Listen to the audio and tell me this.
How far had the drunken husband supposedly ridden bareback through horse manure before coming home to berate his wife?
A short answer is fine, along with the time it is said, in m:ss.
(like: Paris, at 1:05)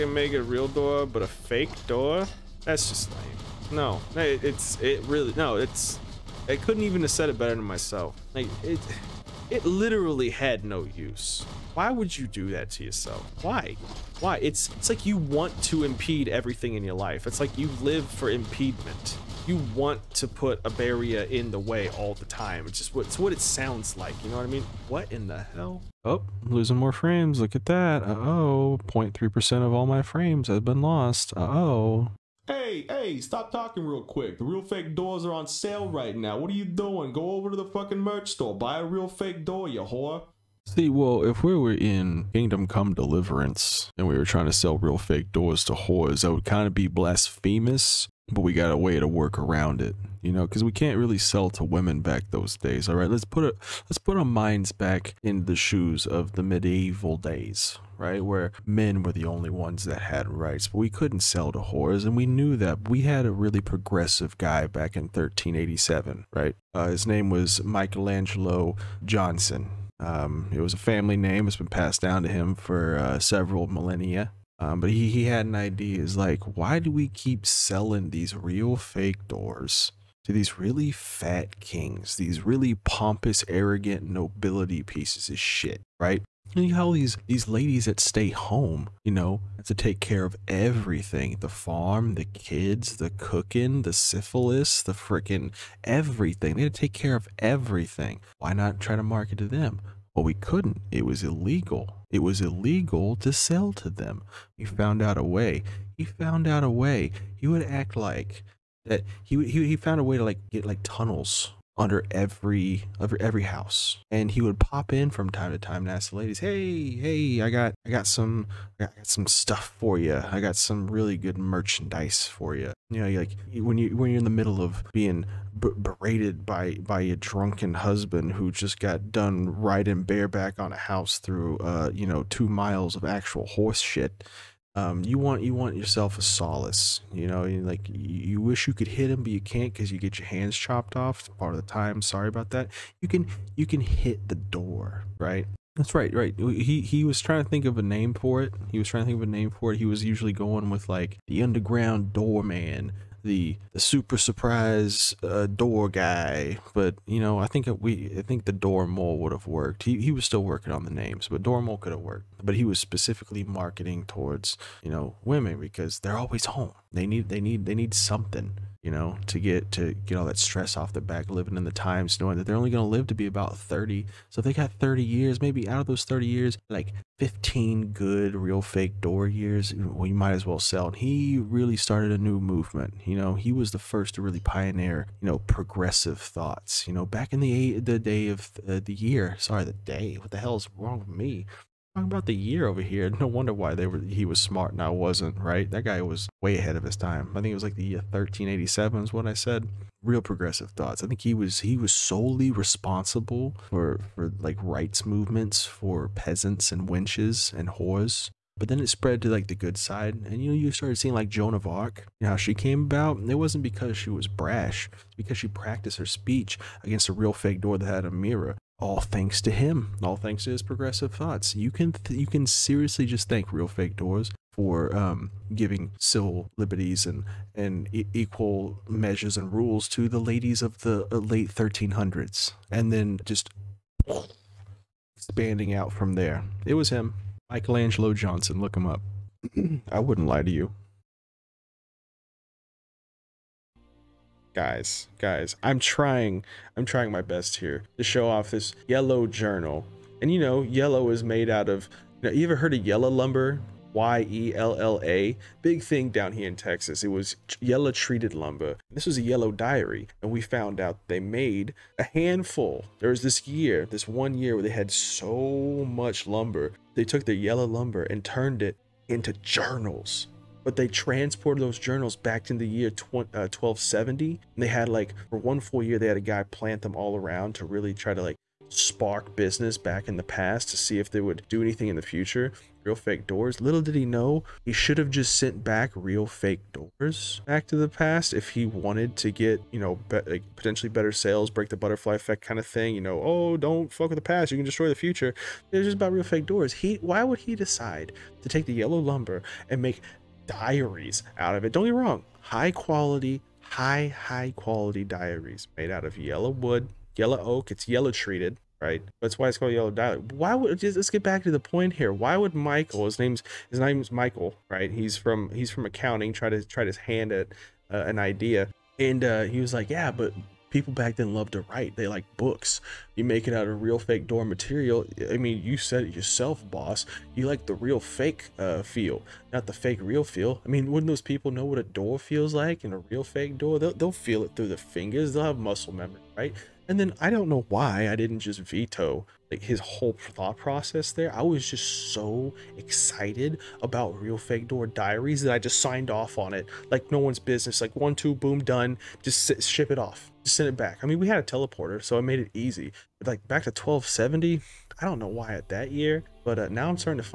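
2 miles, at 2:12.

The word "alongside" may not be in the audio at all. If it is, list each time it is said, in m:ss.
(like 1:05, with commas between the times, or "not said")
not said.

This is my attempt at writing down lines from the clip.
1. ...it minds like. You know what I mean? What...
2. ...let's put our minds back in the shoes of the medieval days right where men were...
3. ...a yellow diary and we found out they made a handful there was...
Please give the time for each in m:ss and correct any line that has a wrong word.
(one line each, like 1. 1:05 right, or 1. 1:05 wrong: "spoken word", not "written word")
1. 0:23 wrong: "sounds", not "minds"
2. 0:53 right
3. 4:19 right.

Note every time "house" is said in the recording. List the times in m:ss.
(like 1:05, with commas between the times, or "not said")
1:53, 2:10.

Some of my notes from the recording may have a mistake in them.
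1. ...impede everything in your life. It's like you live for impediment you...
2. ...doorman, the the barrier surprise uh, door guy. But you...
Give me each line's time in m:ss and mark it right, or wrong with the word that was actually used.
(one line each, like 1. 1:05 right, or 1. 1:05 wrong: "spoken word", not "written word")
1. 0:15 right
2. 2:32 wrong: "super", not "barrier".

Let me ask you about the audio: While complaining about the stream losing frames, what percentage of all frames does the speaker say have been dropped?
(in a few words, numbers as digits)
0.3%.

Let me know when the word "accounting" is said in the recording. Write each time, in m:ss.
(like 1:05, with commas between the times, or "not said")
5:15.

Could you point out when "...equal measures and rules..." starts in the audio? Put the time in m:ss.
3:48.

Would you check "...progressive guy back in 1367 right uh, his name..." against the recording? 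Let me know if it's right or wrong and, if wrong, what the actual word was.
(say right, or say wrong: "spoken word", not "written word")
wrong: "1387", not "1367".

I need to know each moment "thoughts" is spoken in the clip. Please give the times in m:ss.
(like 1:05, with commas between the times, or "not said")
3:06, 3:20, 3:41, 5:40.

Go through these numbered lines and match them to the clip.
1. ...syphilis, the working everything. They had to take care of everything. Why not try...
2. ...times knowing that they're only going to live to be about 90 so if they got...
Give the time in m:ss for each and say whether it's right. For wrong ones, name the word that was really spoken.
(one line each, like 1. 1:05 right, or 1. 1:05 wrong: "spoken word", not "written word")
1. 1:33 wrong: "freaking", not "working"
2. 2:51 wrong: "30", not "90".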